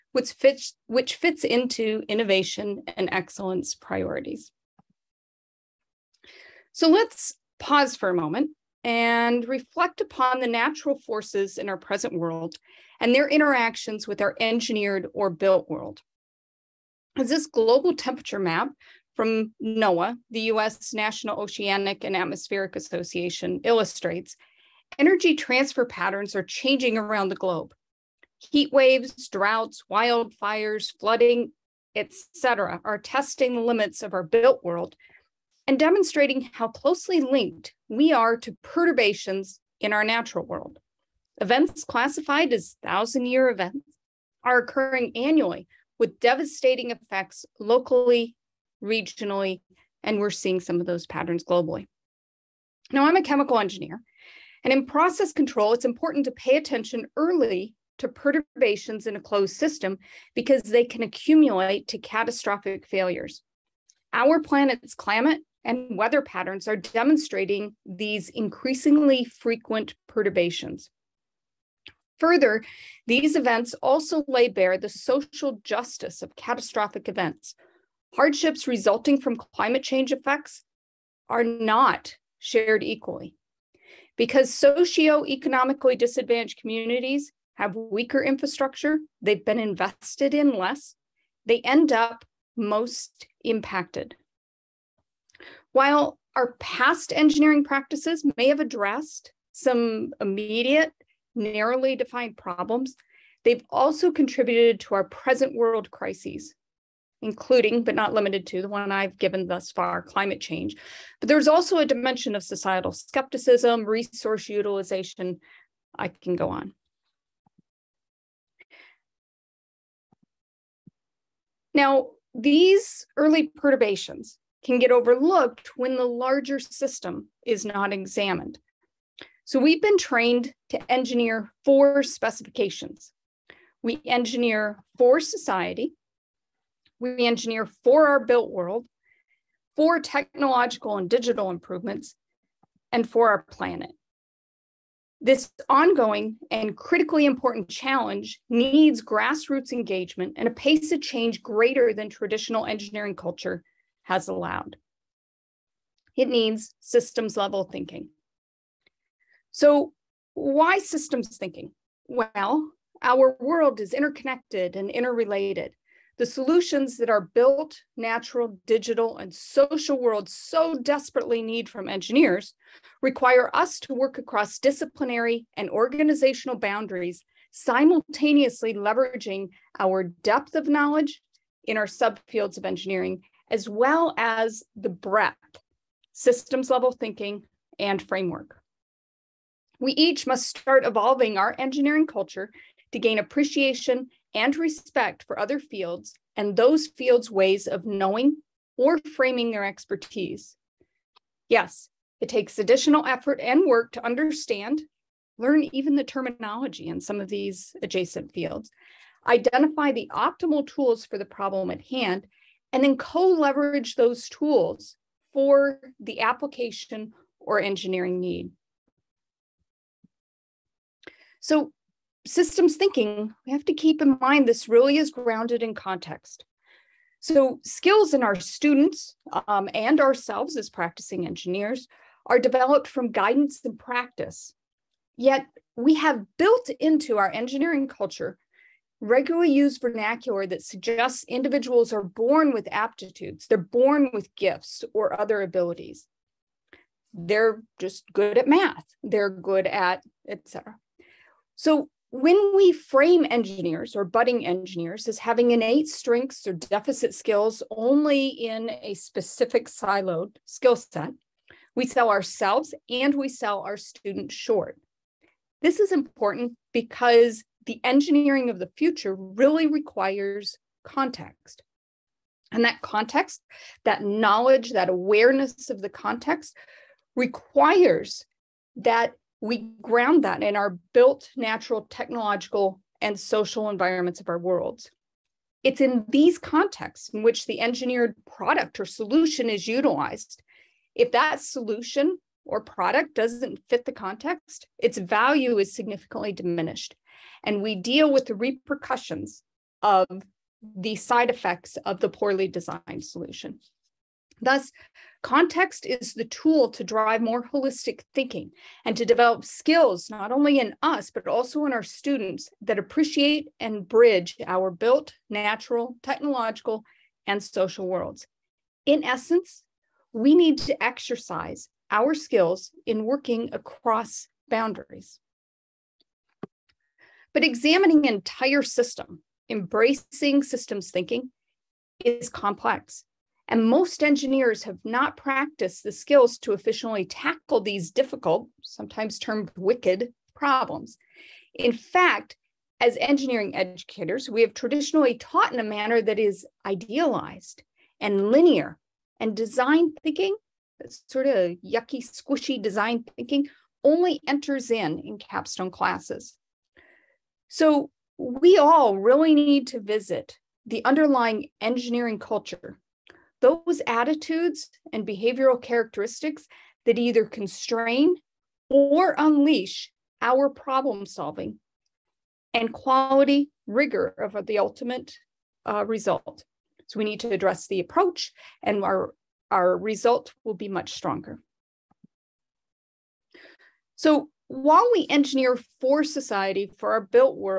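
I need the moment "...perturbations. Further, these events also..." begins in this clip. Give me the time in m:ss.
1:10.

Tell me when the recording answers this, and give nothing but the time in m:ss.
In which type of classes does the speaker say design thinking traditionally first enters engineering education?
5:55.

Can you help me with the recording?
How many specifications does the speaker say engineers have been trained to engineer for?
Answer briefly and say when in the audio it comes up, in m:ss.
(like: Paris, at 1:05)
4, at 2:11.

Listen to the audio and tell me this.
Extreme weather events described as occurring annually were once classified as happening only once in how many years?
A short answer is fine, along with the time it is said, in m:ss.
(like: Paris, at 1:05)
1000, at 0:42.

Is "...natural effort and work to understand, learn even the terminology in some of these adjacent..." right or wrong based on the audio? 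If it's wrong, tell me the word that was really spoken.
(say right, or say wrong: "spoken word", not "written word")
wrong: "additional", not "natural".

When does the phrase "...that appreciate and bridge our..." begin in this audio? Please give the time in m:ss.
5:12.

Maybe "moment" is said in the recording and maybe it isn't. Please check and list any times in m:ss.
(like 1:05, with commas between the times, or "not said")
0:08.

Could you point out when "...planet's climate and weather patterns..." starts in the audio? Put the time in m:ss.
1:04.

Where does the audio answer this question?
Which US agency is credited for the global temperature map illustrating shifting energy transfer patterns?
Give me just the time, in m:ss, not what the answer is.
0:19.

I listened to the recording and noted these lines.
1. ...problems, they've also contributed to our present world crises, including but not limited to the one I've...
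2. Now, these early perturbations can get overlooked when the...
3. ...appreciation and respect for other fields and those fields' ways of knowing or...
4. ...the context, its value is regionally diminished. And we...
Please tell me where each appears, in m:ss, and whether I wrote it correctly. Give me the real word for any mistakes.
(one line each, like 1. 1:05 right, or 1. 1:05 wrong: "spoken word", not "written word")
1. 1:42 right
2. 2:01 right
3. 3:13 right
4. 4:53 wrong: "significantly", not "regionally".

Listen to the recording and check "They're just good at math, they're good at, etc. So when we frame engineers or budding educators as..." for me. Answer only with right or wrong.
wrong.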